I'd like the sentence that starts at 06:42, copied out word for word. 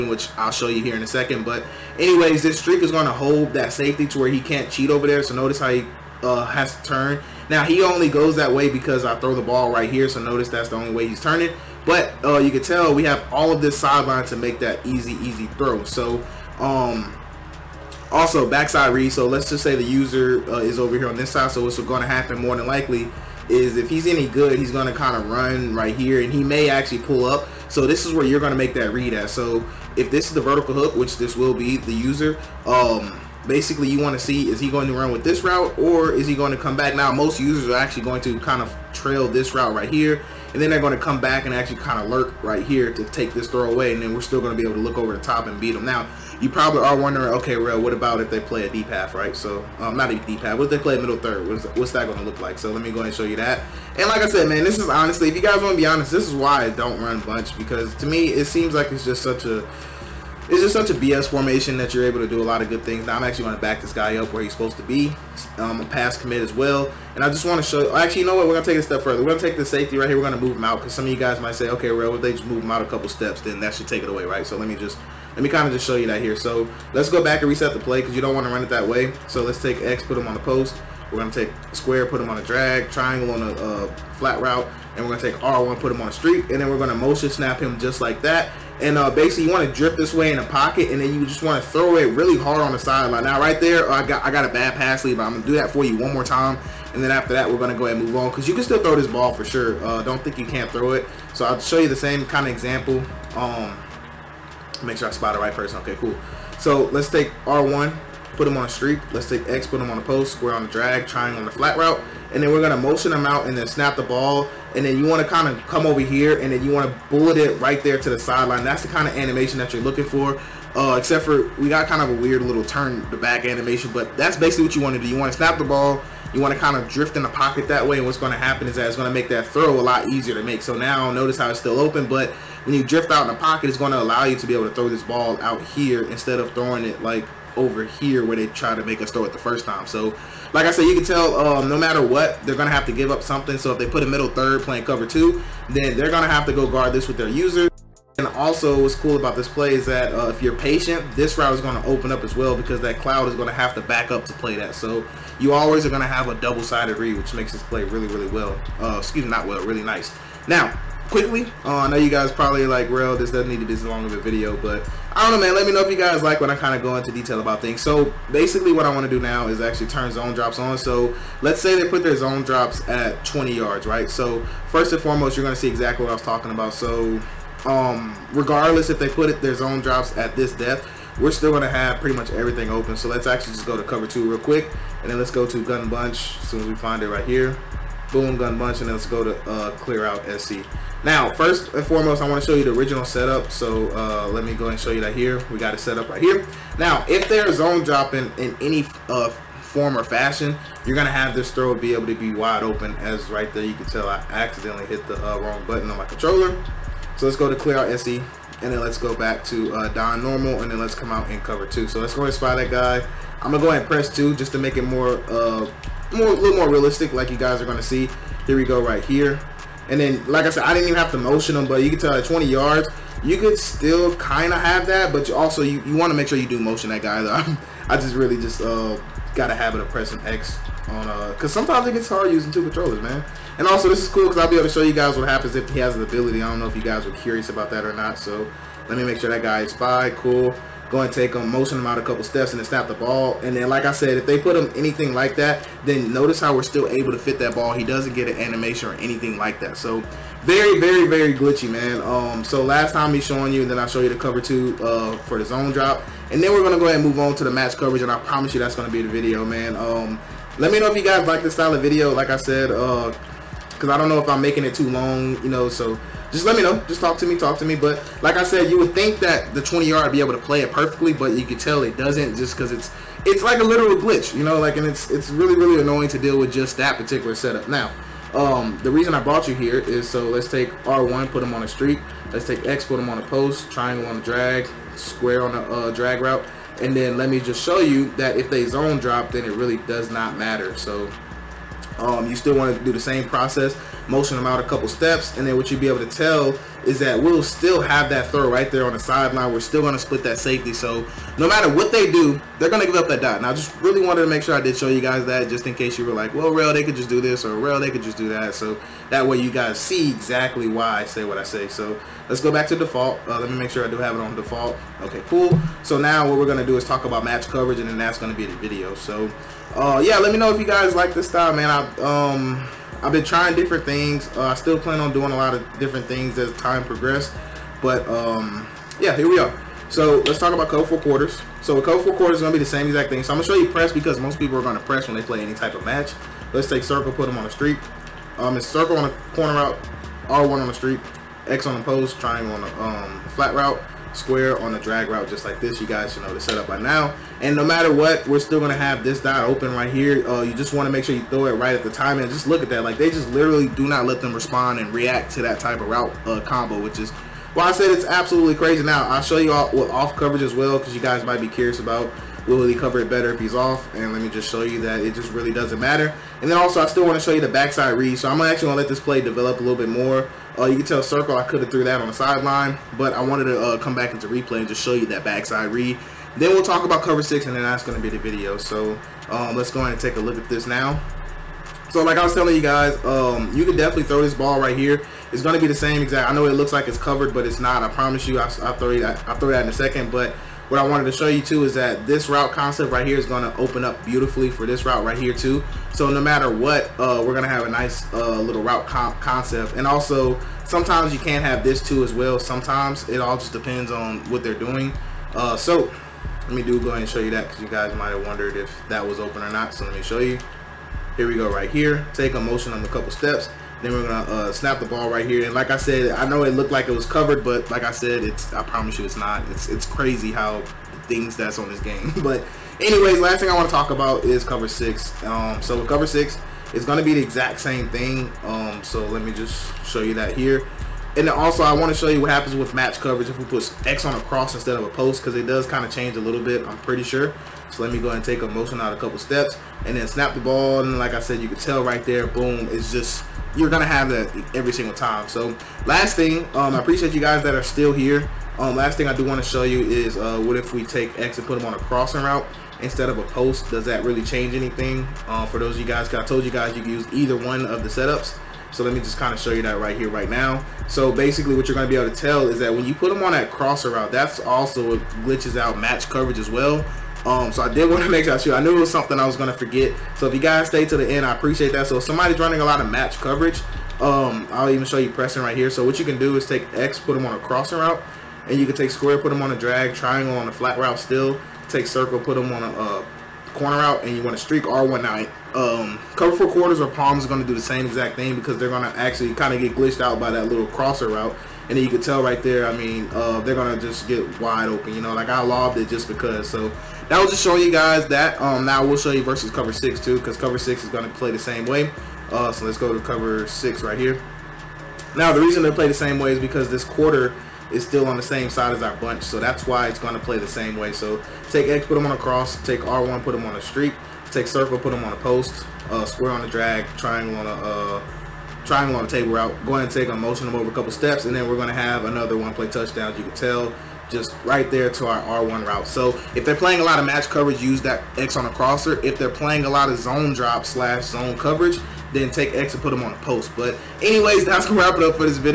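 Sometimes it all just depends on what they're doing.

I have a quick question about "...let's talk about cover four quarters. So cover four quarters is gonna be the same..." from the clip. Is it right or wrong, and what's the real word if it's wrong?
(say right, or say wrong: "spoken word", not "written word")
right.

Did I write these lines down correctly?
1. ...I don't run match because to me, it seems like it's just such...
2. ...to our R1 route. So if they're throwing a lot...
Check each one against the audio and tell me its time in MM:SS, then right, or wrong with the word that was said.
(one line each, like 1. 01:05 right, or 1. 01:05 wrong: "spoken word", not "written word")
1. 00:56 wrong: "bunch", not "match"
2. 08:44 wrong: "playing", not "throwing".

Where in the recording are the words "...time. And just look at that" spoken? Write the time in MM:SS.
05:51.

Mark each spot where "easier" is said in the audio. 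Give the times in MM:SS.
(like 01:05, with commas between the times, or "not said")
02:10.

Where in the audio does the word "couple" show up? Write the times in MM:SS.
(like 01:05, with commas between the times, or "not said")
01:12, 04:02, 04:54, 06:52, 07:18, 08:40.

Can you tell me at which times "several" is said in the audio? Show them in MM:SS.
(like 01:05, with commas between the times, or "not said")
not said.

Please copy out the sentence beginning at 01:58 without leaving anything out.
That's the kind of animation that you're looking for.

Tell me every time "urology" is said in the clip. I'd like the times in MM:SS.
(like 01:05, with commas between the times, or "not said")
not said.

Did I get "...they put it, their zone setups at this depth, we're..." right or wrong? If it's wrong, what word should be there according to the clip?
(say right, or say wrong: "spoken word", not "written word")
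wrong: "drops", not "setups".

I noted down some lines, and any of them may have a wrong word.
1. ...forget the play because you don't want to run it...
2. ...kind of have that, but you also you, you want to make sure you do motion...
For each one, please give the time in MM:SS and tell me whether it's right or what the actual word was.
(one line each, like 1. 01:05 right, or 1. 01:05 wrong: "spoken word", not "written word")
1. 01:17 wrong: "reset", not "forget"
2. 03:44 right.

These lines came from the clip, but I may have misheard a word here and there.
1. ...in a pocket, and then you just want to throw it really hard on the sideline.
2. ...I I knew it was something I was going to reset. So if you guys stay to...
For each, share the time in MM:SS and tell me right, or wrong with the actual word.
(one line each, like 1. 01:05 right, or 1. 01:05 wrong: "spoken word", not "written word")
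1. 01:30 right
2. 07:48 wrong: "forget", not "reset".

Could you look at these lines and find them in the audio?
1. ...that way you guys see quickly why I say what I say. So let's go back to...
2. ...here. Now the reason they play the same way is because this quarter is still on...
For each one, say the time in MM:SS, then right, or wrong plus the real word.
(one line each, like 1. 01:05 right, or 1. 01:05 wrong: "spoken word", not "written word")
1. 05:09 wrong: "exactly", not "quickly"
2. 08:23 right.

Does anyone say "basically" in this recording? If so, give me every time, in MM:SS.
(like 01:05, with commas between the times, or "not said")
00:33, 01:29, 02:04, 02:48, 07:41.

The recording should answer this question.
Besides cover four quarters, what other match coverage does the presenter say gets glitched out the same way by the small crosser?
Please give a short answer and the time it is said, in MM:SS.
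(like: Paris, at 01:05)
Palms, at 08:06.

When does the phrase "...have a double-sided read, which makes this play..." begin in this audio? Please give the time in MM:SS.
02:36.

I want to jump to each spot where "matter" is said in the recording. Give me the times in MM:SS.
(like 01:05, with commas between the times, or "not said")
02:21, 04:50, 05:01, 05:47, 06:05, 06:36.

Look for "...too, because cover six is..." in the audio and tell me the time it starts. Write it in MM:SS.
08:19.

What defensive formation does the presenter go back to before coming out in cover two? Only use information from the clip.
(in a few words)
Dime Normal.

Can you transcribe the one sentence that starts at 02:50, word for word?
So let's say they put their zone drops at 20 yards, right?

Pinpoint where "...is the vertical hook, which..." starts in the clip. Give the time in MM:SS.
00:30.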